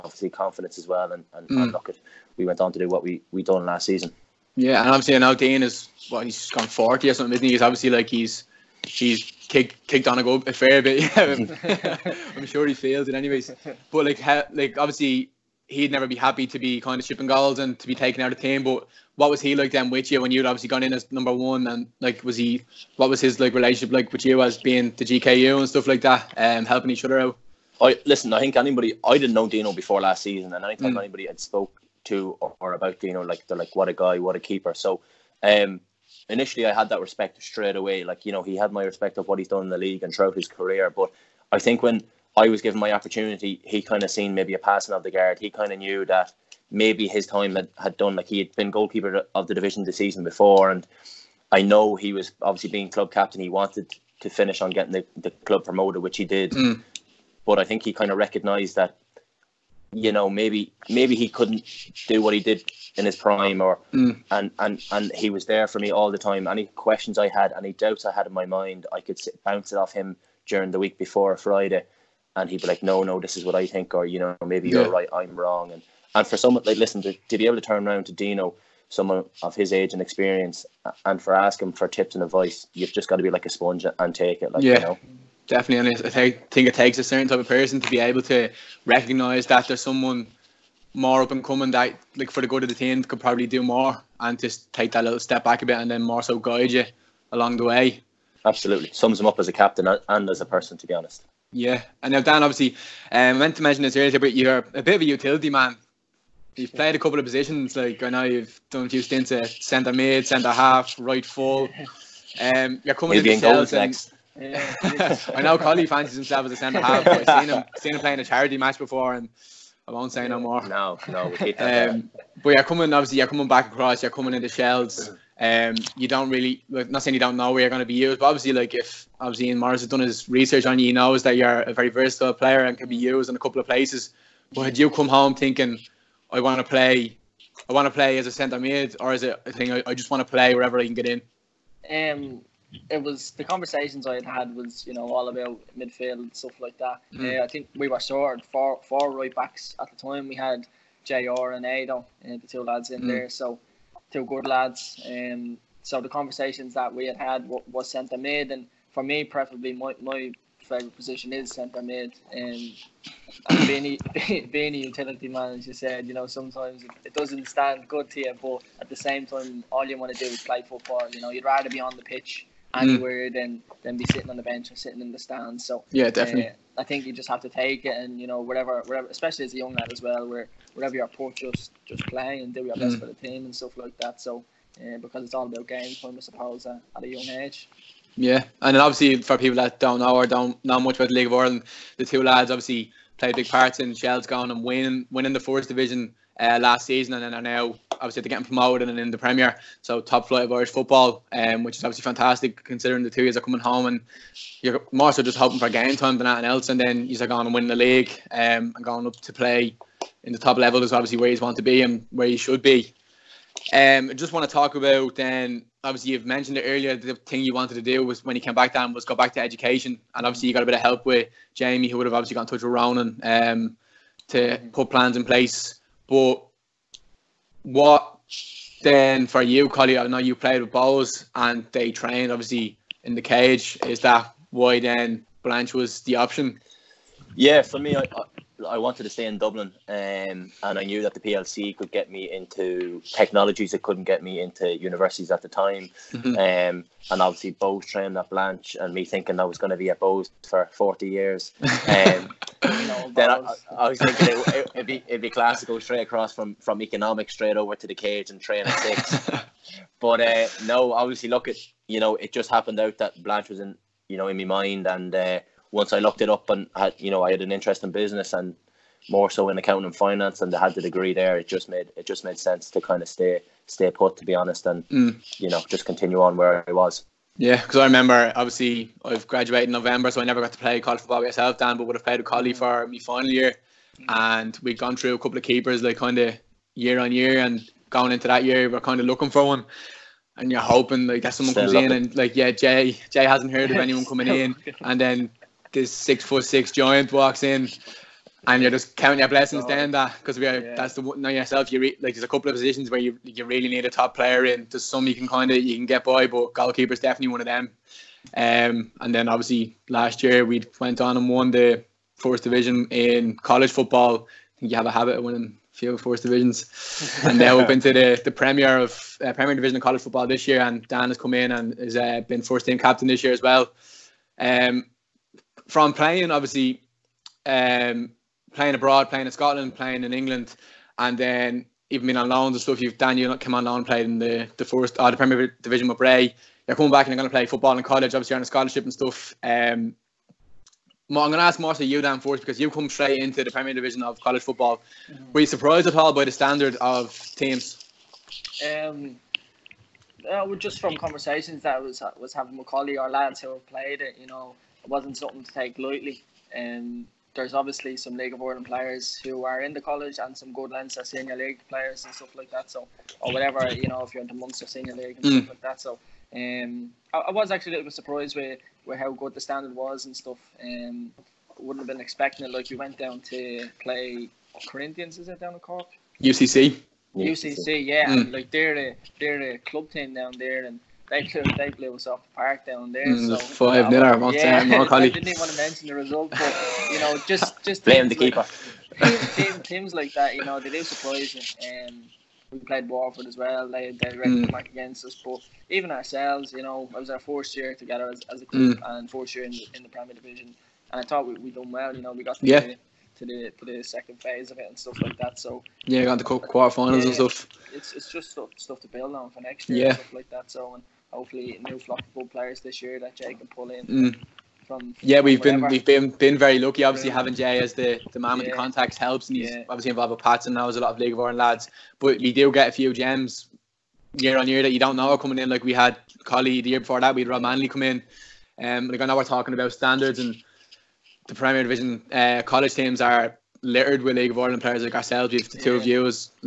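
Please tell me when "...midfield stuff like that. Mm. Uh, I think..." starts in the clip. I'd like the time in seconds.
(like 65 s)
145 s.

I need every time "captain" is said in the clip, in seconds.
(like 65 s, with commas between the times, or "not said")
53 s, 99 s, 322 s.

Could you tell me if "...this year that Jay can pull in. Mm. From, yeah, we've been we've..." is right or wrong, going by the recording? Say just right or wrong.
right.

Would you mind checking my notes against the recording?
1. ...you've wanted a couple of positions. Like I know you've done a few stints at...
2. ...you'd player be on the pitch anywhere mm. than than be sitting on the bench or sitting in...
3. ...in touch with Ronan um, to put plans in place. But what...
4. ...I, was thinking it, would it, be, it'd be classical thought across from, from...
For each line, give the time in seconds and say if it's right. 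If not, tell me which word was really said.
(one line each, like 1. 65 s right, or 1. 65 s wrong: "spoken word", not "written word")
1. 106 s wrong: "played", not "wanted"
2. 171 s wrong: "rather", not "player"
3. 222 s right
4. 253 s wrong: "straight", not "thought".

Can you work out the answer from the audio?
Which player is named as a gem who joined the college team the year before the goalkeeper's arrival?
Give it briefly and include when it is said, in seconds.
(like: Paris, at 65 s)
Rob Manley, at 427 s.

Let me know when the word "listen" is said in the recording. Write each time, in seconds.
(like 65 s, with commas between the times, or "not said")
28 s, 76 s.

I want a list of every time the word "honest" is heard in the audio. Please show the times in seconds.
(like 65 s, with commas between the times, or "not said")
100 s, 274 s.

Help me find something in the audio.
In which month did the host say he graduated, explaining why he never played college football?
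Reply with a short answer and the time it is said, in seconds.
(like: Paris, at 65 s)
November, at 279 s.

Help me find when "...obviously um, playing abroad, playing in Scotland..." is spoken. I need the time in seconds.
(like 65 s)
326 s.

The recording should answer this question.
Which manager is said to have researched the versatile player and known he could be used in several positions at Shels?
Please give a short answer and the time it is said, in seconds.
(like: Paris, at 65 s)
Ian Morris, at 129 s.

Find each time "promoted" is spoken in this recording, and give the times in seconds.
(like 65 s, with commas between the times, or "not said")
55 s, 198 s.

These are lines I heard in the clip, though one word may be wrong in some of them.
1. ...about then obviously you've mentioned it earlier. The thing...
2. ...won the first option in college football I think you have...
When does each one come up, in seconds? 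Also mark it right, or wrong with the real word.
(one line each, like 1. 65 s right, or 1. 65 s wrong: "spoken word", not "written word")
1. 214 s right
2. 311 s wrong: "division", not "option".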